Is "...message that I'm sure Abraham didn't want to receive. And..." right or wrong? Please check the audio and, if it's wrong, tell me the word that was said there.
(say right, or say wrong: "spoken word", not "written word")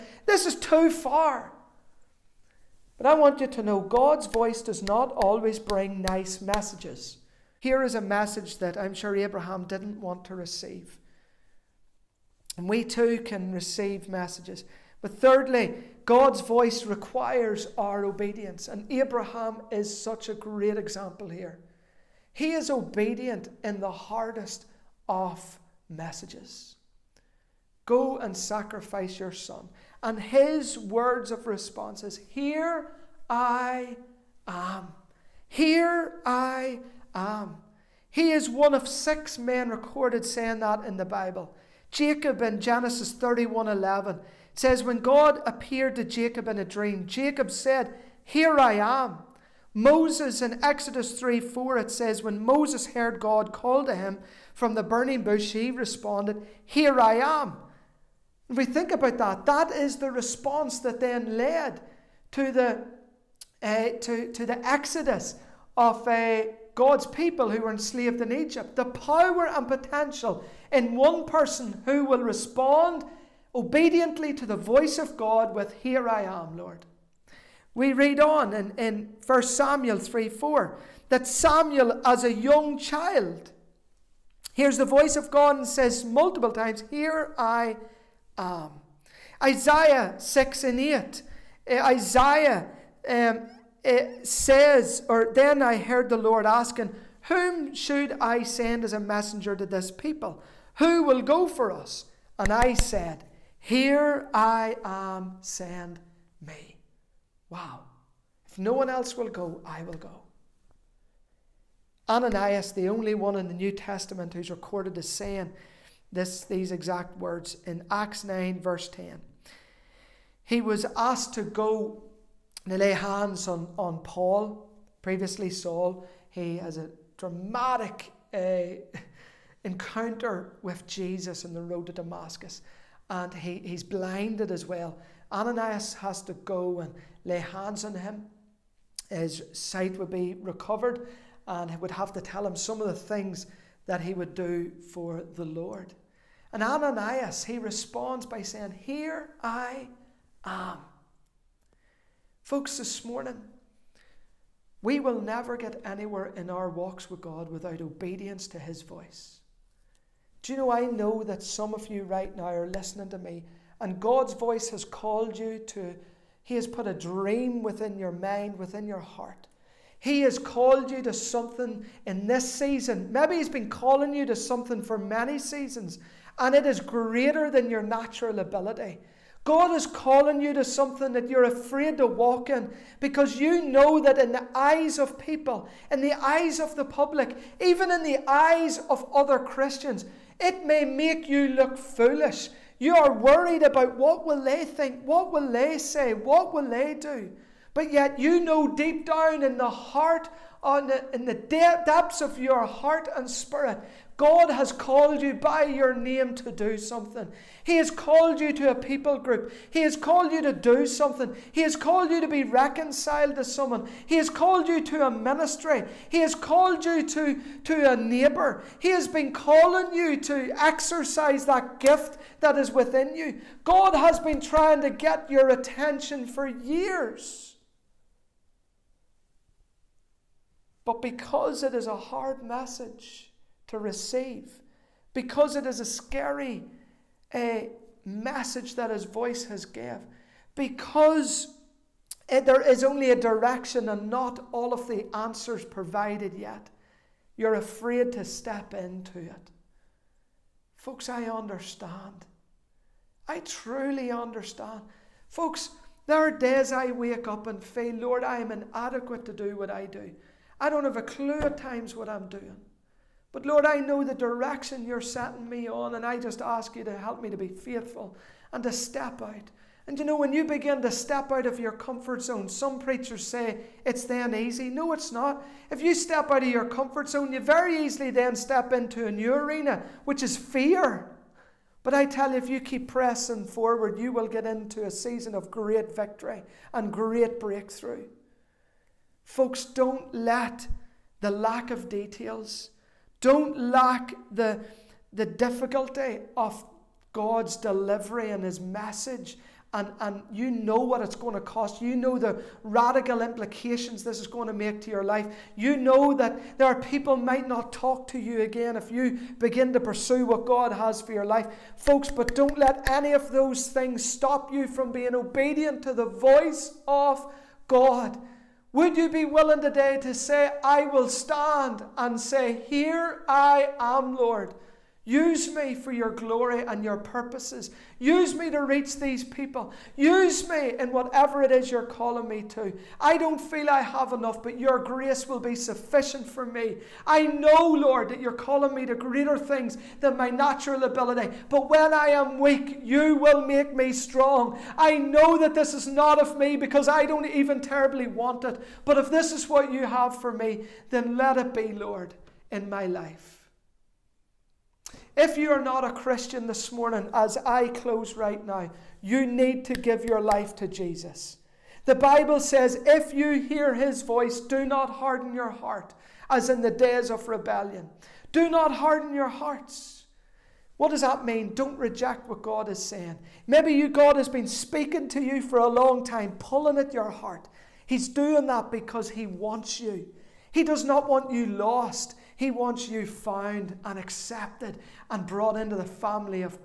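right.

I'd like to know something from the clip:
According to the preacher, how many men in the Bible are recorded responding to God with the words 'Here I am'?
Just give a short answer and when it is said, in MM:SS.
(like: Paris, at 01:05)
6, at 00:38.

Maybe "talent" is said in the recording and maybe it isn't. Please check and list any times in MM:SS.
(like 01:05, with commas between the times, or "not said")
not said.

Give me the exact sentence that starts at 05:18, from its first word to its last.
Would you be willing today to say, I will stand and say, Here I am, Lord.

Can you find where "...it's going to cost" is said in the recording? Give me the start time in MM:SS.
05:01.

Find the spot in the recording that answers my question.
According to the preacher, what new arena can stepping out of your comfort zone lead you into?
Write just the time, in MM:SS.
04:40.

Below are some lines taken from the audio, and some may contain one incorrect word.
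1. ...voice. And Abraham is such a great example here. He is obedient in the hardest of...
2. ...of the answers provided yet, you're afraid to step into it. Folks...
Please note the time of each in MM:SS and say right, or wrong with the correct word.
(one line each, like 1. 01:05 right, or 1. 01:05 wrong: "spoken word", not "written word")
1. 00:18 wrong: "obedience", not "voice"
2. 04:04 right.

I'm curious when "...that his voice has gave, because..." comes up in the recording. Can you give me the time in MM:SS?
03:58.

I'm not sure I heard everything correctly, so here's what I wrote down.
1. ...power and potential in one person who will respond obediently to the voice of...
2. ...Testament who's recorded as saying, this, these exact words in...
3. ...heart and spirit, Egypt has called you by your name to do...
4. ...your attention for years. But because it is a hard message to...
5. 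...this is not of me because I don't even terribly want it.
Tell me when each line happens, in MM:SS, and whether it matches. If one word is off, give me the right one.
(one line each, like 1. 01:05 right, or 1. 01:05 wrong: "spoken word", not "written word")
1. 01:08 right
2. 01:53 right
3. 03:22 wrong: "God", not "Egypt"
4. 03:45 right
5. 05:45 right.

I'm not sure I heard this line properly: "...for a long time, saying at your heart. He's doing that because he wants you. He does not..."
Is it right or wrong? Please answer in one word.
wrong.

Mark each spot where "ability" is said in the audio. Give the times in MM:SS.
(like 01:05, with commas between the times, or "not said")
02:58, 05:40.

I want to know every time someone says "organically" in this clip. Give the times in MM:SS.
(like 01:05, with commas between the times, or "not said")
not said.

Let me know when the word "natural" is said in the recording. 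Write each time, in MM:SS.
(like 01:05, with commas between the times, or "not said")
02:57, 05:40.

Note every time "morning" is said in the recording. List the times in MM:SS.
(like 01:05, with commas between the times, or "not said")
02:33, 05:56.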